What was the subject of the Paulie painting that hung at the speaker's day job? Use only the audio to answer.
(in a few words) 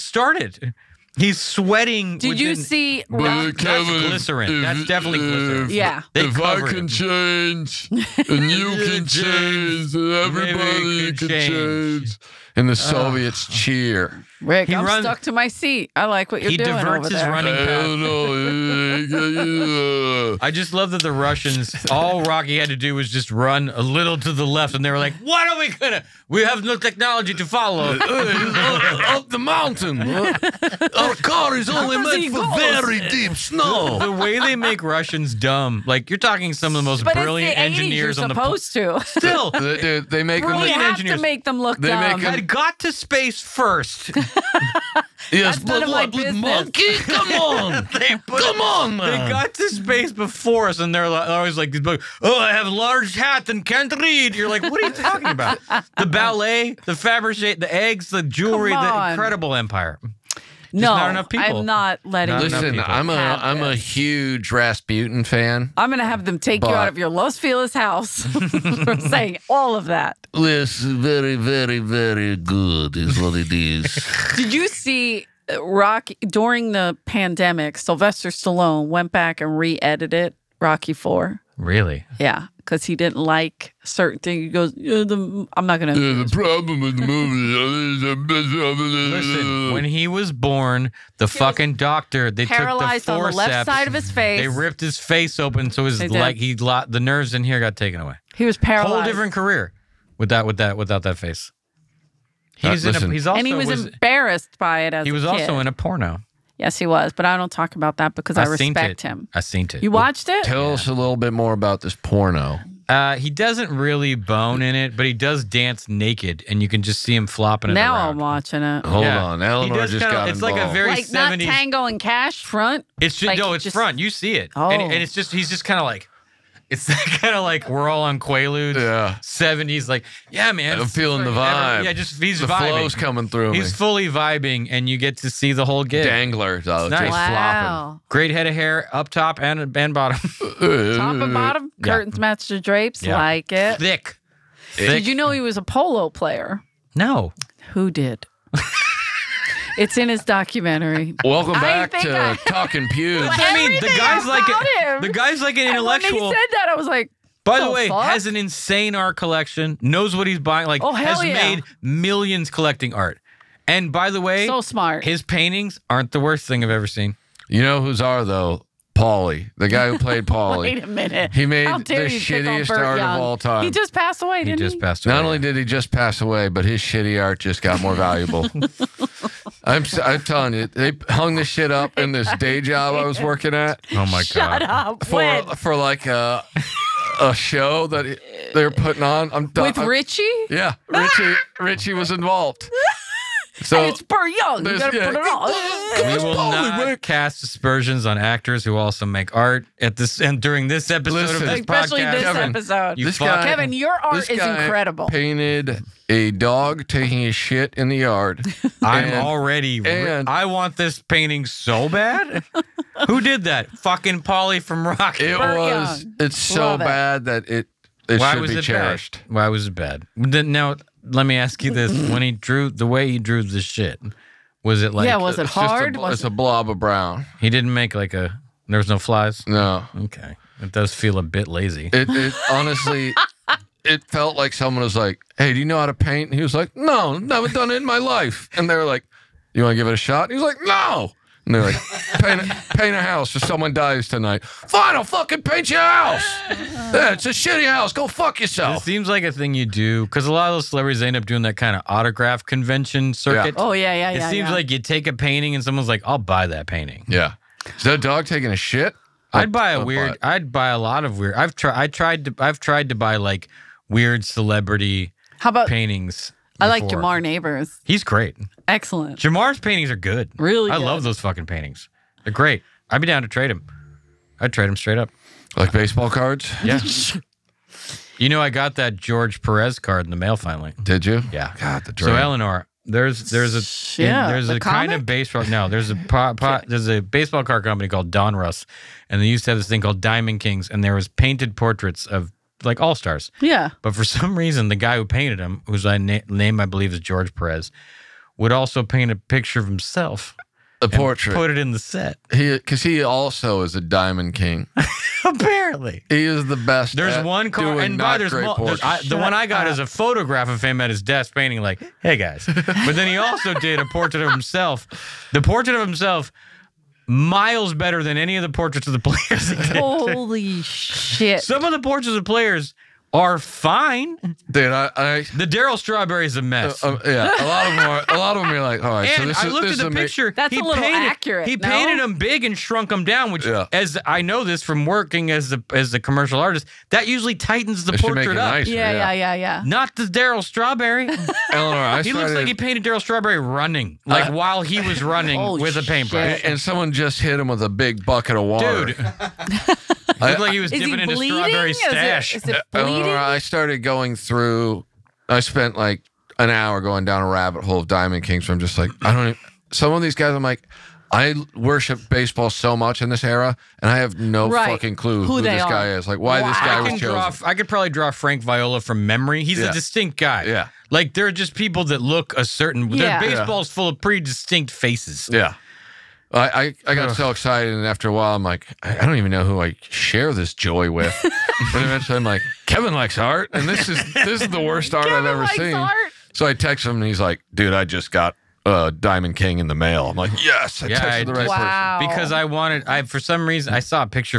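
A dog taking a shit.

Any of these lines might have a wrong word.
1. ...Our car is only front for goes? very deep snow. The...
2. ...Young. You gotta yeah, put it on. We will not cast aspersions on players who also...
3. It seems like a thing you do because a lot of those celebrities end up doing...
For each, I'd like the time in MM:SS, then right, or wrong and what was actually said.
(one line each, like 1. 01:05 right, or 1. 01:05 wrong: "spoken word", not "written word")
1. 00:30 wrong: "meant", not "front"
2. 03:14 wrong: "actors", not "players"
3. 04:08 right.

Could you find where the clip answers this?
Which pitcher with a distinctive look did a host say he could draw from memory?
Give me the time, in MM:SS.
06:08.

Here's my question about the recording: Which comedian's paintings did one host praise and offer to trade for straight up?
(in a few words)
Jamar Neighbors.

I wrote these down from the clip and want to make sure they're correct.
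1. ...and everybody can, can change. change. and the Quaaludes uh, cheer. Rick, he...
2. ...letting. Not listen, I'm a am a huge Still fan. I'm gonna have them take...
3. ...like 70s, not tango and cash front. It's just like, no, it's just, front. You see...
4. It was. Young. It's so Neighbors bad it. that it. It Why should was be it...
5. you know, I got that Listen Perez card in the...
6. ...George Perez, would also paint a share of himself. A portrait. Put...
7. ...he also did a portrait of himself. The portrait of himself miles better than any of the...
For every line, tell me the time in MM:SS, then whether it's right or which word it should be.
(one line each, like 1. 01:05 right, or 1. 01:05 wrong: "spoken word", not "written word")
1. 00:09 wrong: "Soviets", not "Quaaludes"
2. 01:02 wrong: "Rasputin", not "Still"
3. 02:00 right
4. 03:35 wrong: "Love", not "Neighbors"
5. 04:38 wrong: "George", not "Listen"
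6. 04:56 wrong: "picture", not "share"
7. 05:13 right.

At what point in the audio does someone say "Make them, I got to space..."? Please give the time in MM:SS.
00:41.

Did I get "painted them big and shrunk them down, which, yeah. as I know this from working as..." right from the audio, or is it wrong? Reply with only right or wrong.
right.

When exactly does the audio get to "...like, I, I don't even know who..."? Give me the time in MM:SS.
06:18.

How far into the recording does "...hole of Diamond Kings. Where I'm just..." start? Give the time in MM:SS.
05:57.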